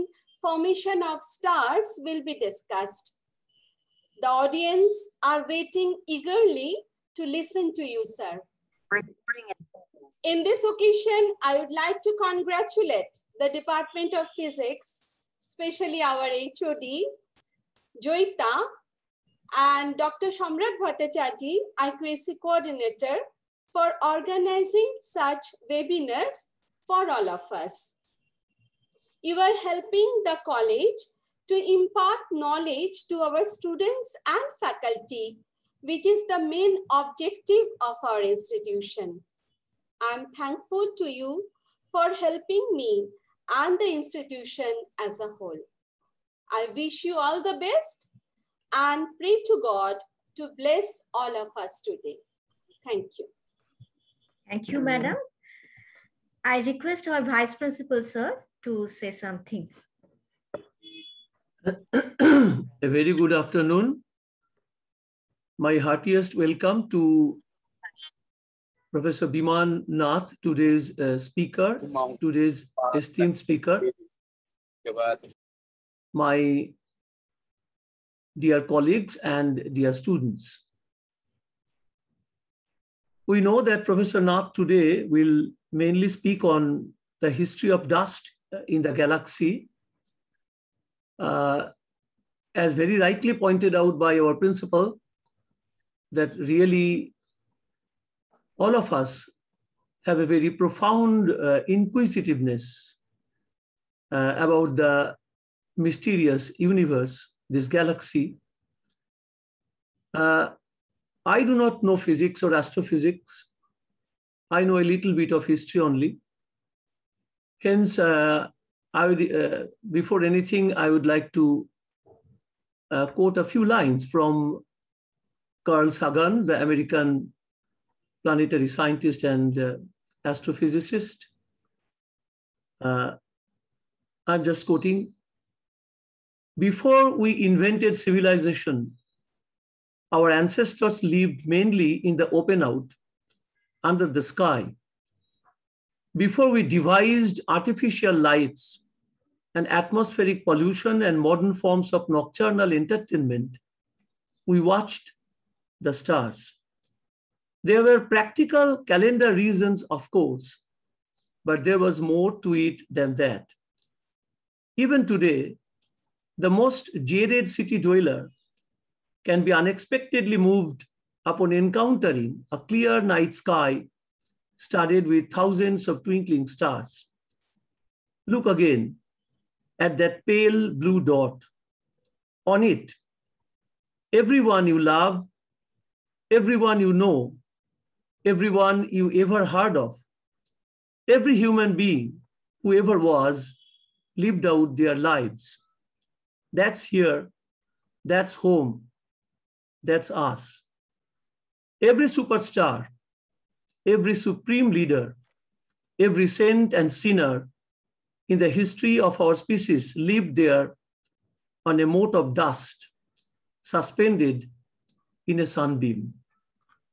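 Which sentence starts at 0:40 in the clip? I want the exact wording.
I'm thankful to you for helping me and the institution as a whole.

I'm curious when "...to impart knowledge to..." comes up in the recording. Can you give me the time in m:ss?
0:31.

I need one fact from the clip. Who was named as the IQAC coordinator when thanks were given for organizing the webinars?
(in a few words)
Dr. Samrat Bhattacharji.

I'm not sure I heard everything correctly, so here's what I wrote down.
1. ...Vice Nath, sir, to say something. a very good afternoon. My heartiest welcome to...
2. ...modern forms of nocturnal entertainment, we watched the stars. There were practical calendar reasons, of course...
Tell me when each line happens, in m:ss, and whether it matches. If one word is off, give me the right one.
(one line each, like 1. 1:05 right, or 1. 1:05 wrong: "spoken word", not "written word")
1. 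0:57 wrong: "Principal", not "Nath"
2. 2:31 right.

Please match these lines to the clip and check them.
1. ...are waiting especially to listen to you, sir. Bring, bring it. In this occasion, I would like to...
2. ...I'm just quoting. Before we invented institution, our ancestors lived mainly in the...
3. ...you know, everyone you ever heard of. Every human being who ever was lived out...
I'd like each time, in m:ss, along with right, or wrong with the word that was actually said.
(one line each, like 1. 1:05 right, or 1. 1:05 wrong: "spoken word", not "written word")
1. 0:05 wrong: "eagerly", not "especially"
2. 2:14 wrong: "civilization", not "institution"
3. 3:06 right.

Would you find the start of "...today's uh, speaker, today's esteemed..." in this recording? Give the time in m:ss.
1:10.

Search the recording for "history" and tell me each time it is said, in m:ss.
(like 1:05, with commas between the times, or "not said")
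1:27, 1:55, 3:28.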